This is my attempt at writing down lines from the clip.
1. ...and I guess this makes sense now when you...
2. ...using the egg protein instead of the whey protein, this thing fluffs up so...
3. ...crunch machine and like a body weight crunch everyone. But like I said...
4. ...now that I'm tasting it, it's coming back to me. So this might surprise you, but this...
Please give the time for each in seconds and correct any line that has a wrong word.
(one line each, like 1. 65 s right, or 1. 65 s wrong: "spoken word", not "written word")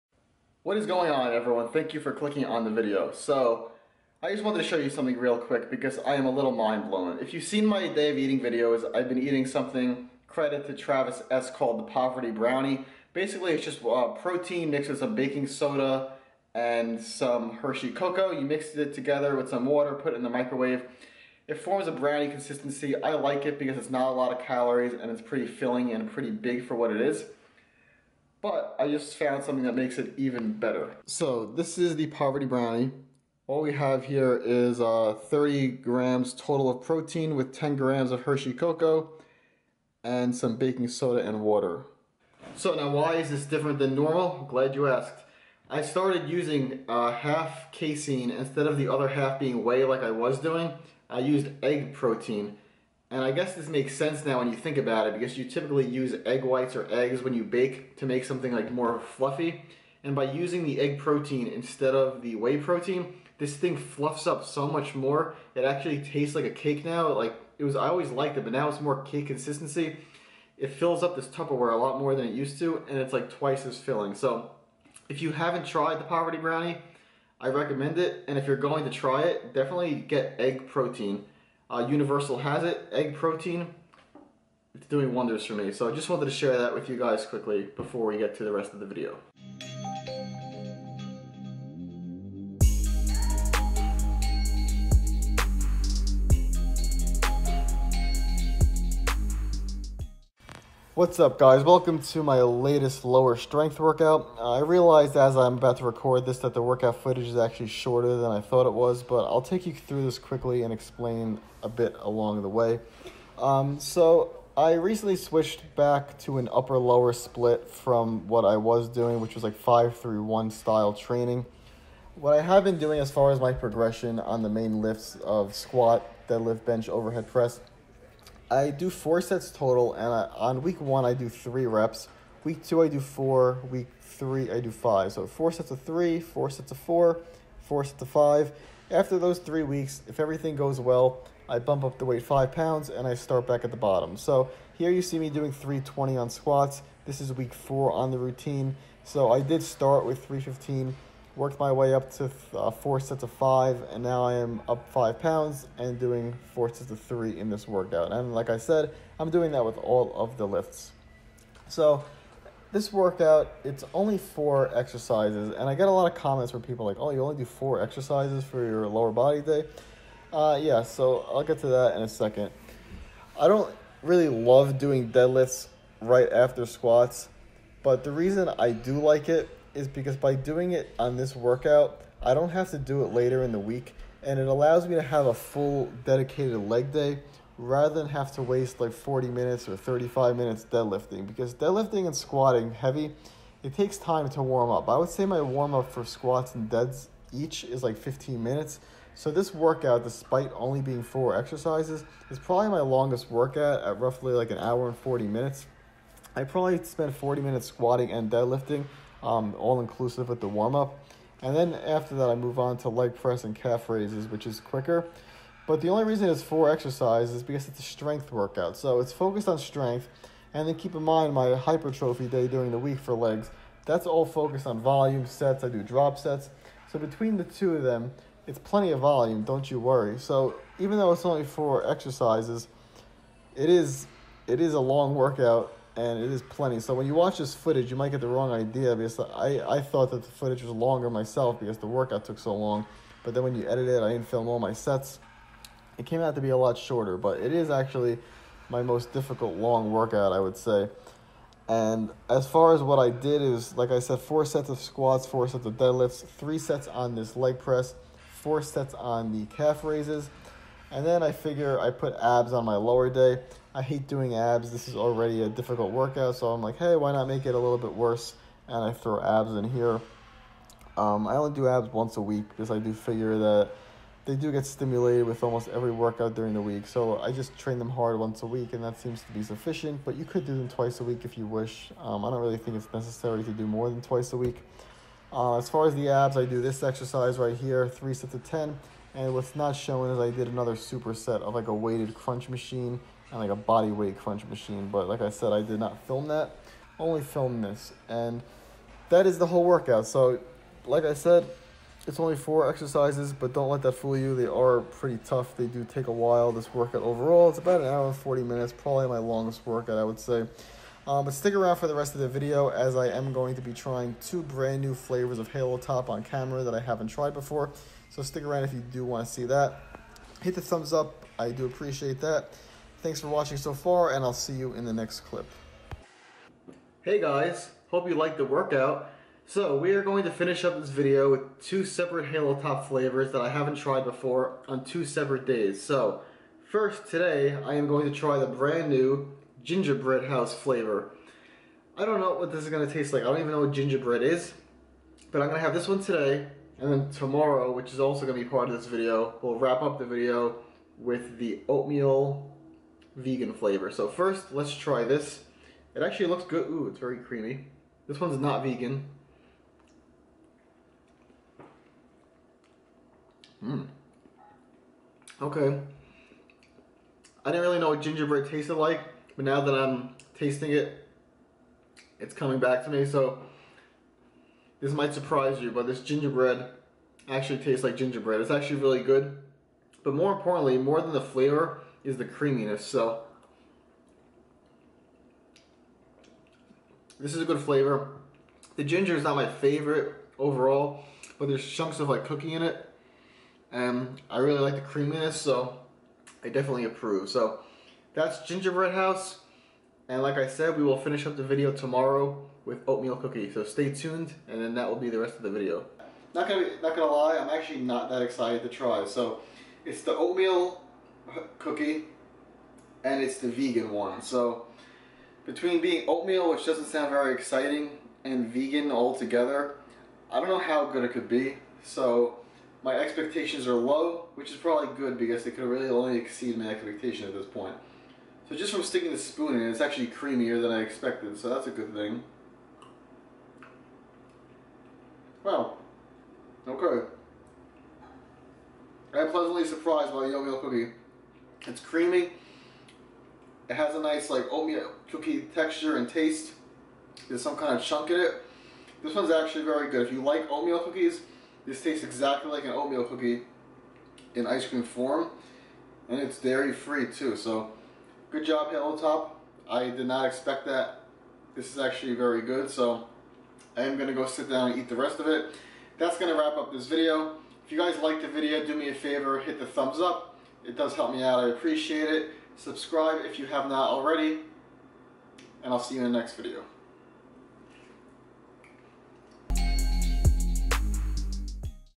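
1. 53 s right
2. 60 s right
3. 292 s wrong: "machine", not "everyone"
4. 369 s right.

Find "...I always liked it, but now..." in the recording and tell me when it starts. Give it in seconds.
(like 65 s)
67 s.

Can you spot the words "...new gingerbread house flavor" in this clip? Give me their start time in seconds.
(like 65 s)
338 s.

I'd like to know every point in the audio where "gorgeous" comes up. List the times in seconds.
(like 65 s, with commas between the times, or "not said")
not said.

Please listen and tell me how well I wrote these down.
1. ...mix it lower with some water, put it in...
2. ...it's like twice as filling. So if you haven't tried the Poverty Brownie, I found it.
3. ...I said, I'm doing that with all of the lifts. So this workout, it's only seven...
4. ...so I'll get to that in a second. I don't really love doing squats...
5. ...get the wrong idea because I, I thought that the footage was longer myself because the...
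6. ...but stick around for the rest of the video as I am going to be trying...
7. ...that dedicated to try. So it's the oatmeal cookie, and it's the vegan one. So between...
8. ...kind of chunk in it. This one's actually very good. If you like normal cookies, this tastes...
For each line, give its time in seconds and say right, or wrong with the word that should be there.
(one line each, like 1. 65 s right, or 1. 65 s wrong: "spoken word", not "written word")
1. 18 s wrong: "together", not "lower"
2. 72 s wrong: "recommend", not "found"
3. 158 s wrong: "four", not "seven"
4. 170 s wrong: "deadlifts", not "squats"
5. 238 s right
6. 311 s right
7. 408 s wrong: "excited", not "dedicated"
8. 447 s wrong: "oatmeal", not "normal".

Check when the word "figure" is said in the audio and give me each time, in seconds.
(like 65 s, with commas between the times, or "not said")
261 s, 272 s.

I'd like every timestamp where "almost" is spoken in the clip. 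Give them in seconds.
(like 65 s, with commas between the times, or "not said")
275 s.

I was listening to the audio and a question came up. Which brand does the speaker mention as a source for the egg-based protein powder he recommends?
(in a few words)
Universal.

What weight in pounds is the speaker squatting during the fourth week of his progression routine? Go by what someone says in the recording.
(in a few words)
320.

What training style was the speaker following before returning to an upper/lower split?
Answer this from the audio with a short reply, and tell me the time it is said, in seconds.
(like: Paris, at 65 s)
5/3/1, at 119 s.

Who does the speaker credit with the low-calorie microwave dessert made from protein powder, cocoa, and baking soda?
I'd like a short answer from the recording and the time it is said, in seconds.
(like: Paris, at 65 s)
Travis S., at 10 s.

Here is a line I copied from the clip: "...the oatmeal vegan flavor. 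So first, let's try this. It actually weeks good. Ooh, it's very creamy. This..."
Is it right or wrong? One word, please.
wrong.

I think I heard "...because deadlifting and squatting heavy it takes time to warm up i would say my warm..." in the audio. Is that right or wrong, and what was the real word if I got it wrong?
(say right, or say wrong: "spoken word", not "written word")
right.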